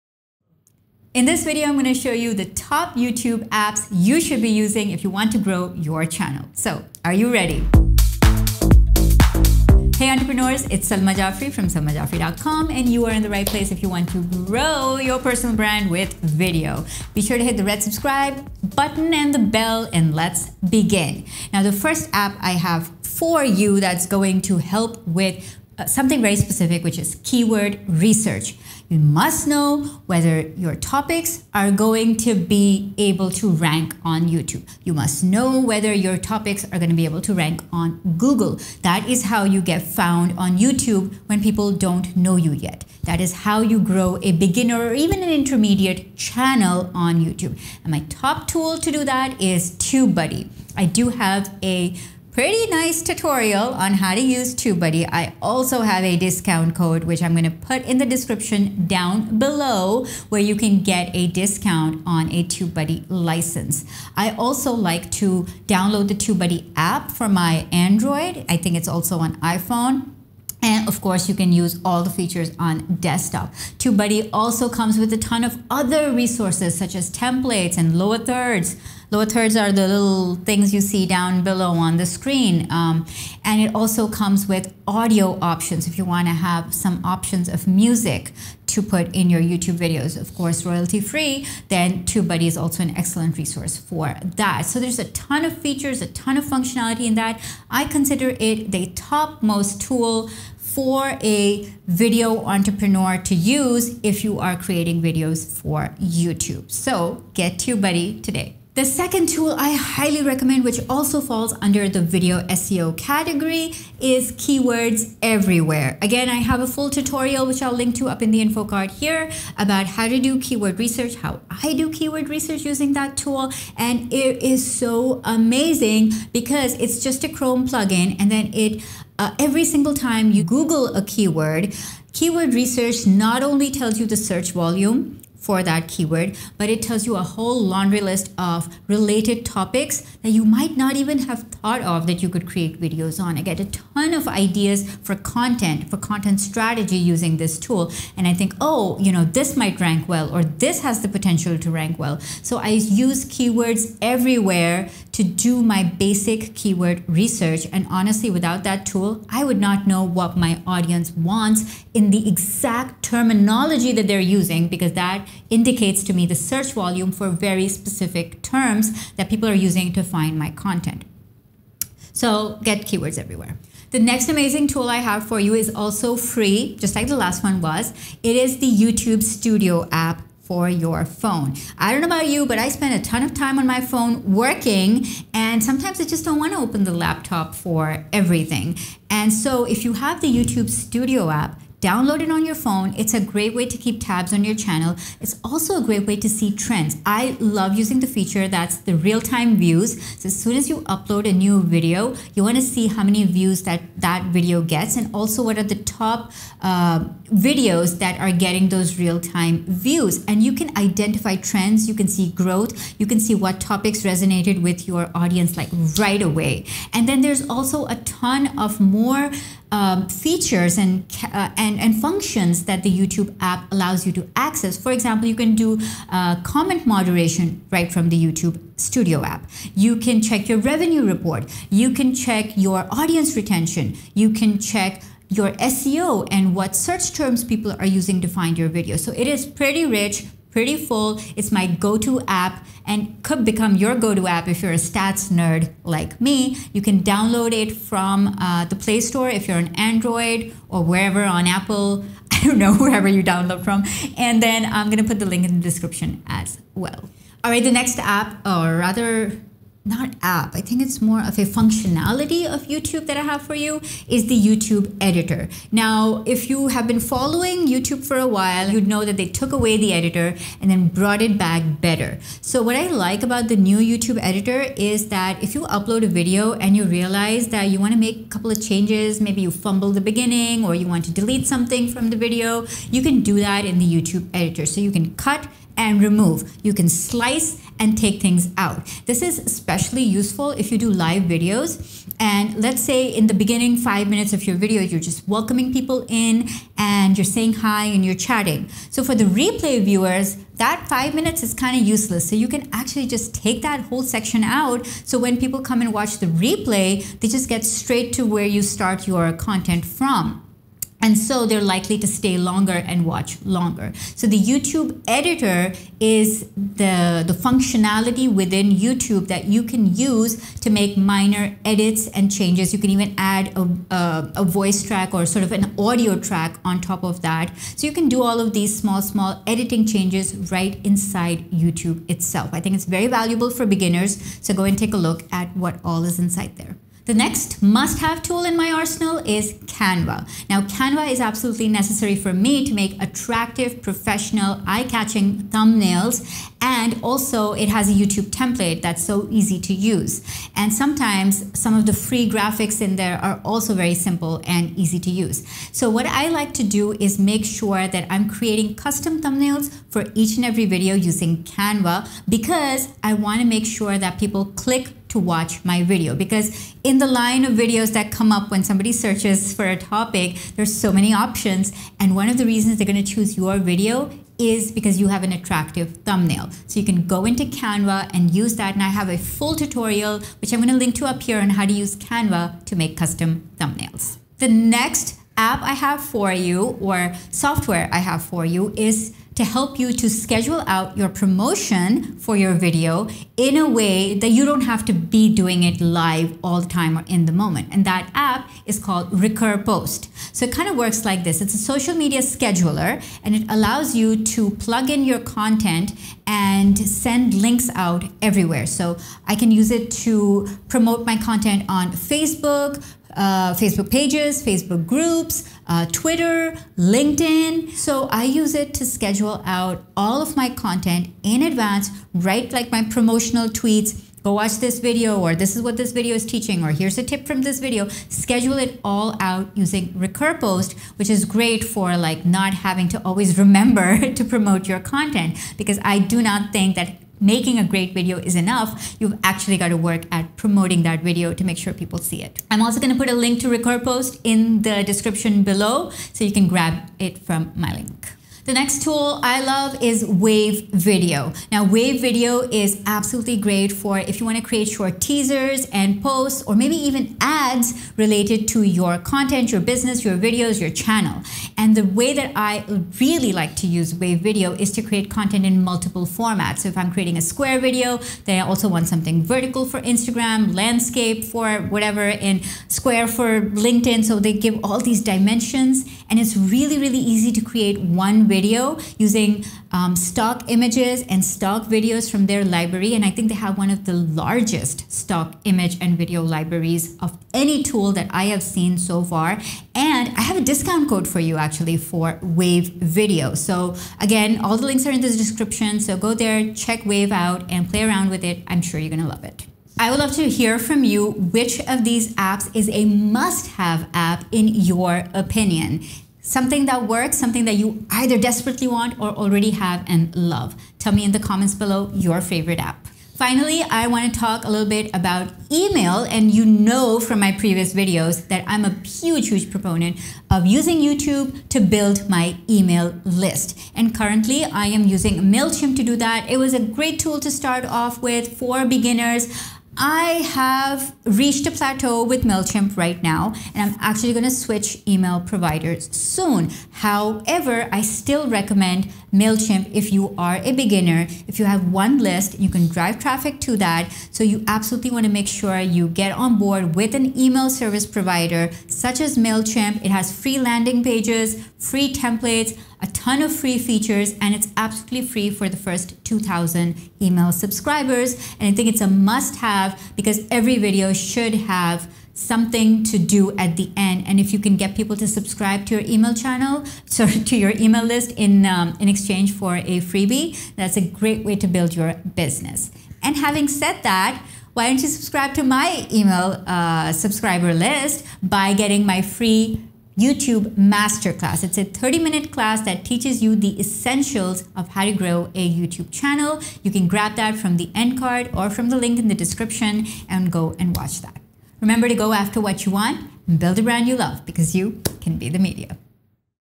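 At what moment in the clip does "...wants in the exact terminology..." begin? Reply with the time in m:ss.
2:41.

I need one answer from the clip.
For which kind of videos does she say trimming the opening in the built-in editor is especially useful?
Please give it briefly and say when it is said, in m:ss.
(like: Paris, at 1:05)
live videos, at 4:50.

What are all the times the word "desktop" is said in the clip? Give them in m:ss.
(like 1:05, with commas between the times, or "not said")
1:12.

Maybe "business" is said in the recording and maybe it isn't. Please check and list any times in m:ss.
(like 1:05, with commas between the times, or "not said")
7:39, 9:32.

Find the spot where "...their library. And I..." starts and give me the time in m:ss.
8:02.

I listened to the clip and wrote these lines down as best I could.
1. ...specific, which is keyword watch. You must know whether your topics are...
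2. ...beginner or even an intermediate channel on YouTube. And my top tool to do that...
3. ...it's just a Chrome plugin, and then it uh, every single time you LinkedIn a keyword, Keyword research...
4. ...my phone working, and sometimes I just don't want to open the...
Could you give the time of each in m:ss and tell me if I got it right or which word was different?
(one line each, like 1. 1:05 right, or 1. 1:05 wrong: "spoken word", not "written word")
1. 0:26 wrong: "research", not "watch"
2. 0:44 right
3. 2:06 wrong: "Google", not "LinkedIn"
4. 3:03 right.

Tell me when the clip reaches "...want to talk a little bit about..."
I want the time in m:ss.
8:33.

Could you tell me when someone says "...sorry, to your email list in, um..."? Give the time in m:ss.
9:26.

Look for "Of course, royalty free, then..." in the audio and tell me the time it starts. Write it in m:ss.
1:30.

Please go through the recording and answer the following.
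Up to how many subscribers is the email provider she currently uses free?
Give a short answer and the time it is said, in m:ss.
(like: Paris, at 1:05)
2,000, at 9:16.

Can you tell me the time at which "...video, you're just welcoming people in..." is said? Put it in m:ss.
4:54.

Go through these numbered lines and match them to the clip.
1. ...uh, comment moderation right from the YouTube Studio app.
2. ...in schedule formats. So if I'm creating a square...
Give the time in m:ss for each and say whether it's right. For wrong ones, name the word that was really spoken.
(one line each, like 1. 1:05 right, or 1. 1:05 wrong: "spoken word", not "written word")
1. 3:46 right
2. 7:45 wrong: "multiple", not "schedule".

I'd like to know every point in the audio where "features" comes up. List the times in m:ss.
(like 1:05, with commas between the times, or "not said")
1:12, 1:35, 3:18, 3:40, 9:13.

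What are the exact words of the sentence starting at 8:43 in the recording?
And currently, I am using MailChimp to do that.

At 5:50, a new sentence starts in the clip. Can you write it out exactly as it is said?
And sometimes some of the free graphics in there are also very simple and easy to use.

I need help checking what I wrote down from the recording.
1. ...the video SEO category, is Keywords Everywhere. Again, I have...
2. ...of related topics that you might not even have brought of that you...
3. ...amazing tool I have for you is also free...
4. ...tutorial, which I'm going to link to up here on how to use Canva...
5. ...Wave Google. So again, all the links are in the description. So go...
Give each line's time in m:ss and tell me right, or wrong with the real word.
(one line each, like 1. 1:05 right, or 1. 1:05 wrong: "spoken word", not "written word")
1. 1:51 right
2. 2:18 wrong: "thought", not "brought"
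3. 2:54 right
4. 6:19 right
5. 8:12 wrong: "Video", not "Google".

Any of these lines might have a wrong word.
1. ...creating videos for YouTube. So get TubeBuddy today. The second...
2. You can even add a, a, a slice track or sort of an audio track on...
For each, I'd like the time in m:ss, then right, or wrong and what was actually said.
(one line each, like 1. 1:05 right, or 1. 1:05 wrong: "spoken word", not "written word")
1. 1:44 right
2. 5:22 wrong: "voice", not "slice".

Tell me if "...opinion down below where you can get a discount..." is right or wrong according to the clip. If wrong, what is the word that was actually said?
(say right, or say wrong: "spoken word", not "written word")
wrong: "description", not "opinion".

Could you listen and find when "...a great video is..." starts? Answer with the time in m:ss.
7:17.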